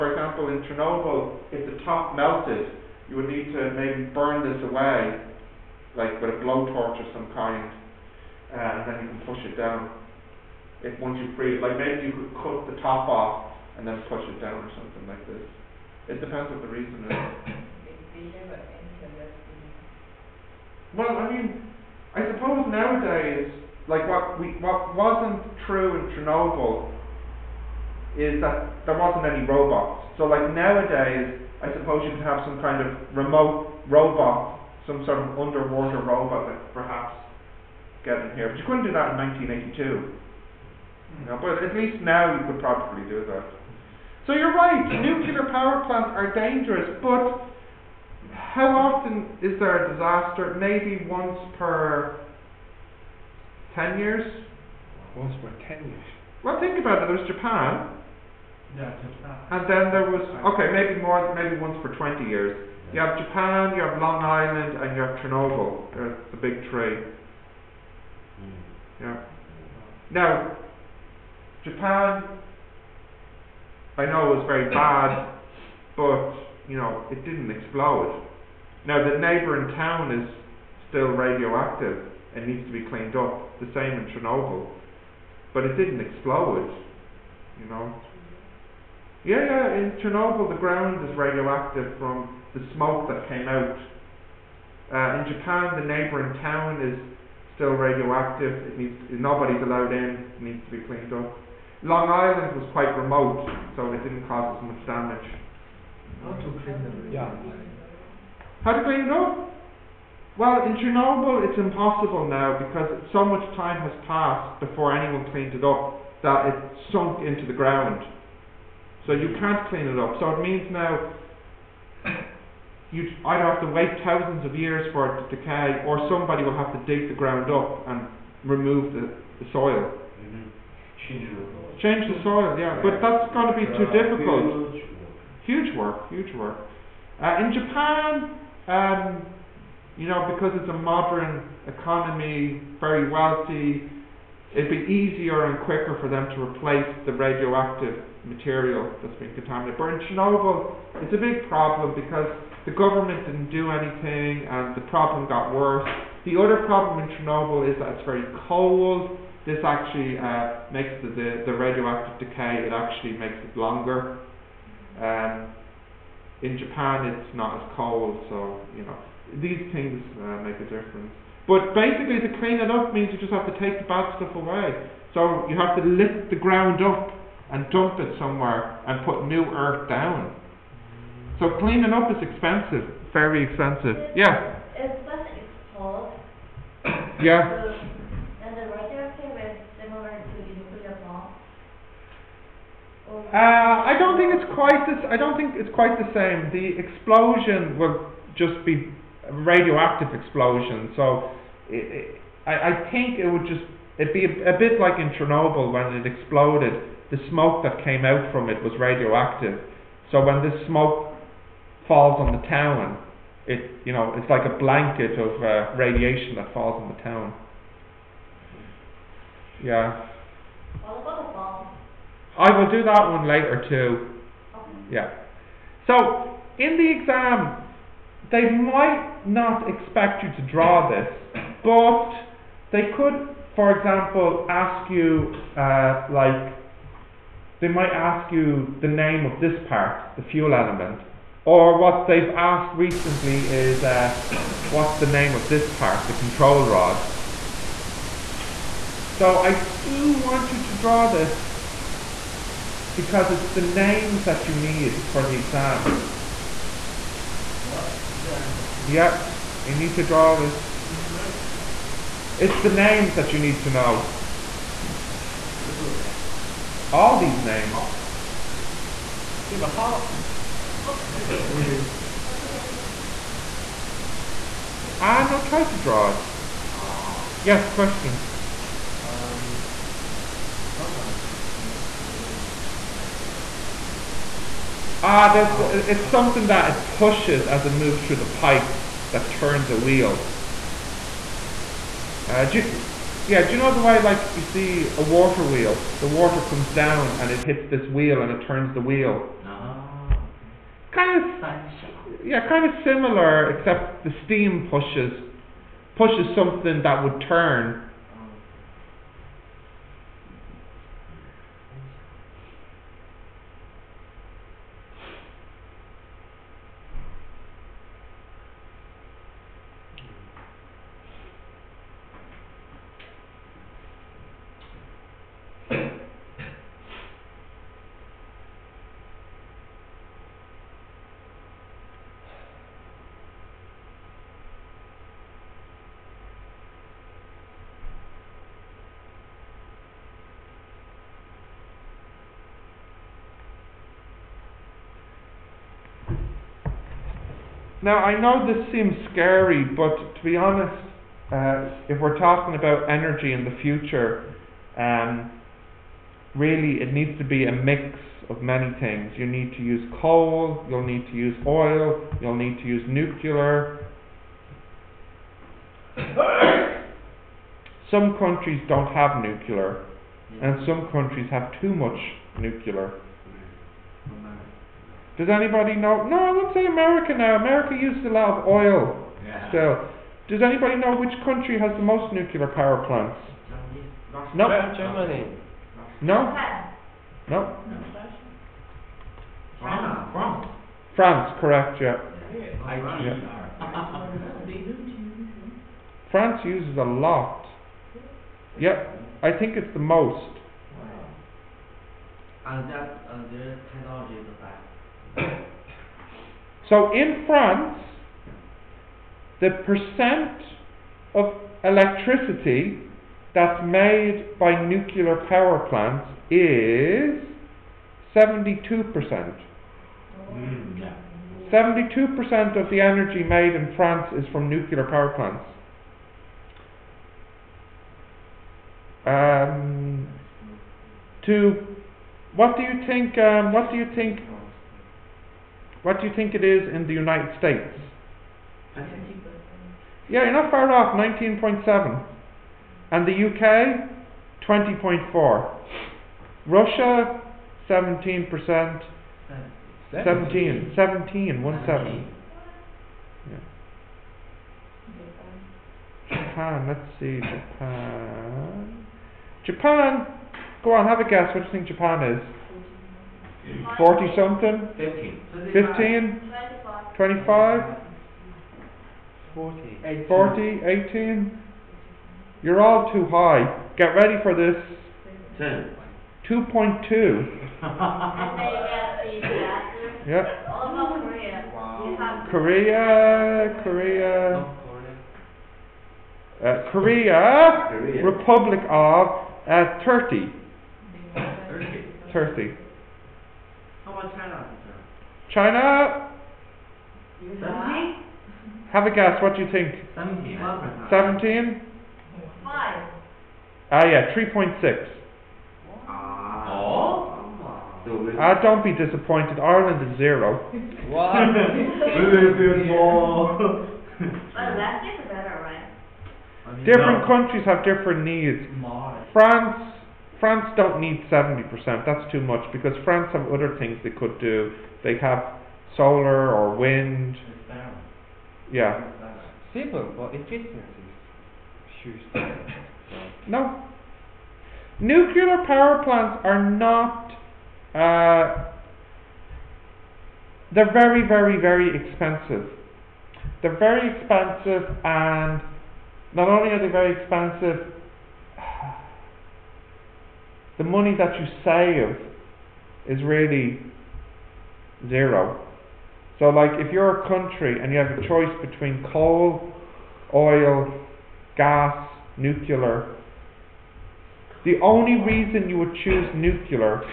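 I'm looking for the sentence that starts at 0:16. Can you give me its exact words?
It depends what the reason is.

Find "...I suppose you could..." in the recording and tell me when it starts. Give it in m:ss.
0:31.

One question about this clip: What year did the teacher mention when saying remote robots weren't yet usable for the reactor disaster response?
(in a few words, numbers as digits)
1982.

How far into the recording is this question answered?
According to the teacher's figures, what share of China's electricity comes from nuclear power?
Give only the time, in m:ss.
8:24.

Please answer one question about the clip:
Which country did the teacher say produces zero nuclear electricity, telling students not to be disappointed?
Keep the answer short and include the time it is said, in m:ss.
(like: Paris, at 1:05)
Ireland, at 8:29.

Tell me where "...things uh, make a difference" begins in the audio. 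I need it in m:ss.
2:49.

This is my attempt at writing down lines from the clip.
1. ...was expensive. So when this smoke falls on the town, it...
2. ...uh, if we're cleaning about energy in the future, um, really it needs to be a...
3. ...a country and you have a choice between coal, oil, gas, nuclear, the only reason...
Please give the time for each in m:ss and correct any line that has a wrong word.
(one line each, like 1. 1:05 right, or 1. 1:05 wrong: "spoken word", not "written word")
1. 3:28 wrong: "radioactive", not "expensive"
2. 5:51 wrong: "talking", not "cleaning"
3. 9:17 right.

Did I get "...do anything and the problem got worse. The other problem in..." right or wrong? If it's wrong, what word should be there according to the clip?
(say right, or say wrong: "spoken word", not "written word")
right.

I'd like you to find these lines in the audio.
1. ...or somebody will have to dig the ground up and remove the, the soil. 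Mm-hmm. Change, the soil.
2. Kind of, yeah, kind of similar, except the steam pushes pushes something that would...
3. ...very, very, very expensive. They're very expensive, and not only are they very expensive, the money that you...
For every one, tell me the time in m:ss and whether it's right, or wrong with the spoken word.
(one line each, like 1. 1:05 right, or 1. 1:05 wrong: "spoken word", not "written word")
1. 2:05 right
2. 5:00 right
3. 9:00 right.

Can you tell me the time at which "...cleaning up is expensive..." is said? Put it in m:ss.
3:01.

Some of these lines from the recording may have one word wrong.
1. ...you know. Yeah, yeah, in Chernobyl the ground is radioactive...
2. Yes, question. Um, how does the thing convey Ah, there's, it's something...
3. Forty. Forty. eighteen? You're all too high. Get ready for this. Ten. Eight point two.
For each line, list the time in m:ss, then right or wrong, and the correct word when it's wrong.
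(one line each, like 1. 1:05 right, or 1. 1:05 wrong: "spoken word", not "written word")
1. 1:27 right
2. 4:37 right
3. 7:49 wrong: "Two", not "Eight".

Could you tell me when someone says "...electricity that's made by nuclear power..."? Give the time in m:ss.
6:51.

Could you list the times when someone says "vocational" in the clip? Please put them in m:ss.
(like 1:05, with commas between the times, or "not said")
not said.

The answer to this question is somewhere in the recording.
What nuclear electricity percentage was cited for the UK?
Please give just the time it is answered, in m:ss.
7:24.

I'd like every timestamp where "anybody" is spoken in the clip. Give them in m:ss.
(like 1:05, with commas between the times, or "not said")
6:15, 6:20.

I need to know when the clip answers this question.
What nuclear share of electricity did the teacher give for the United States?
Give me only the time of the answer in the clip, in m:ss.
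7:20.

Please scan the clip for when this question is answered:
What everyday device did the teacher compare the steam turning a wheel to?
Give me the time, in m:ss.
4:55.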